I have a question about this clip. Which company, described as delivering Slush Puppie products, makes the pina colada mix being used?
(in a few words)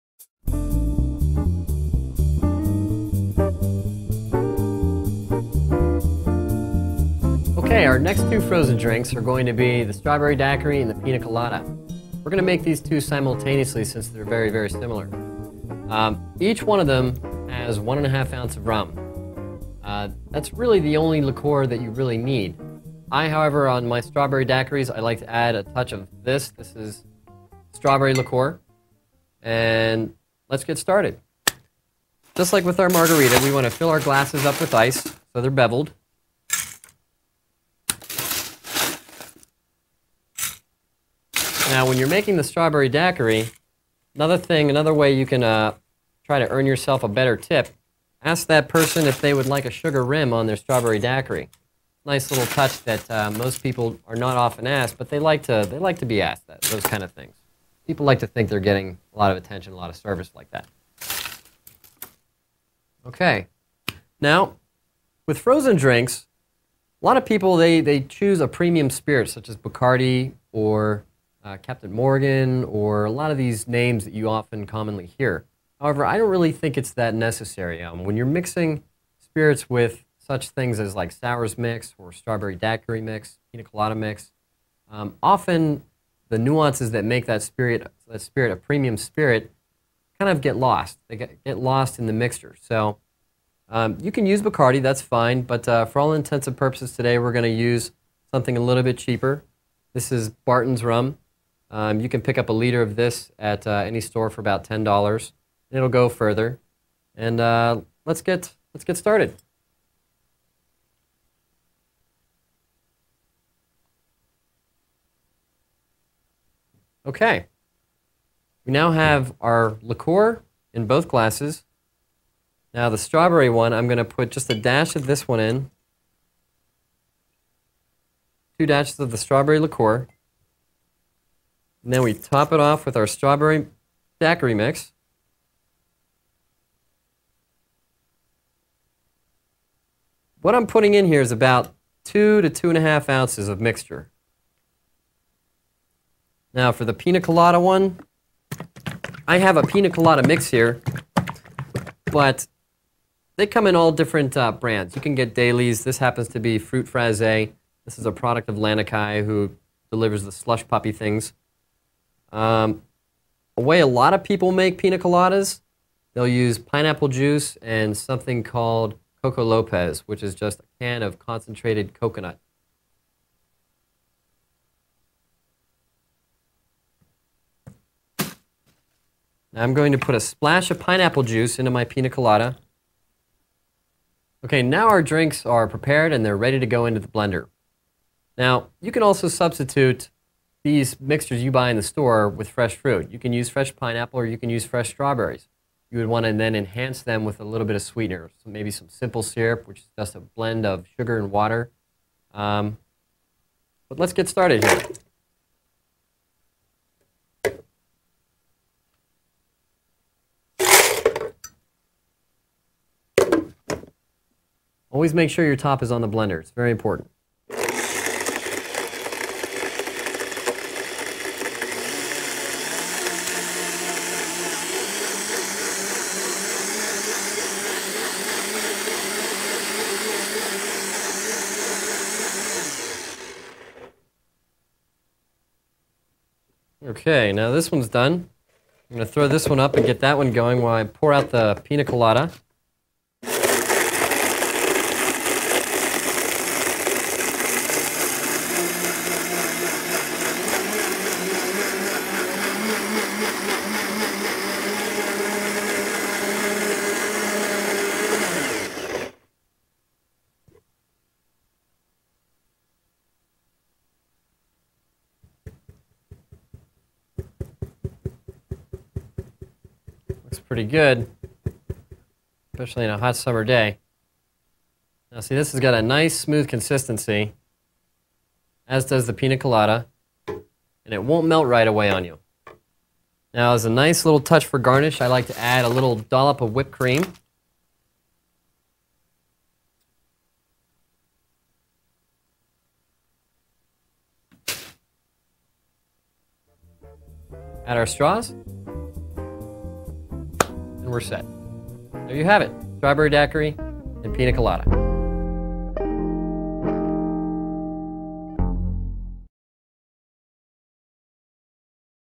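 Lanikai.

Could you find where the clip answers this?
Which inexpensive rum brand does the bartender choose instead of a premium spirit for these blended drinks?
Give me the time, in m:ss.
1:40.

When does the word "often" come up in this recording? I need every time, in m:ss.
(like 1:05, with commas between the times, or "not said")
0:54, 1:14, 1:25.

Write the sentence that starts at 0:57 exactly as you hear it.
People like to think they're getting a lot of attention, a lot of service like that.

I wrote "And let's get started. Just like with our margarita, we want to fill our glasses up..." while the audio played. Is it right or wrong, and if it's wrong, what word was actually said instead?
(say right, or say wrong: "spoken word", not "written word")
right.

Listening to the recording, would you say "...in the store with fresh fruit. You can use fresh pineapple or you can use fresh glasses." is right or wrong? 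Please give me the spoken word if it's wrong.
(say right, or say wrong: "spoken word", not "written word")
wrong: "strawberries", not "glasses".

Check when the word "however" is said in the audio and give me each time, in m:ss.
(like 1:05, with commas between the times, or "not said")
0:23, 1:15.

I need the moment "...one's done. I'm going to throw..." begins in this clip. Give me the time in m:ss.
3:57.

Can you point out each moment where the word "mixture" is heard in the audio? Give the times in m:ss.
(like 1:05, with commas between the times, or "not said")
1:32, 2:23, 3:10.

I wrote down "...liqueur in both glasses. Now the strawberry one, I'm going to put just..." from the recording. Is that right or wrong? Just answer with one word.
right.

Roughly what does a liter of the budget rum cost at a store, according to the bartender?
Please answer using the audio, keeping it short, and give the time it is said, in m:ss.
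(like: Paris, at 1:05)
$10, at 1:44.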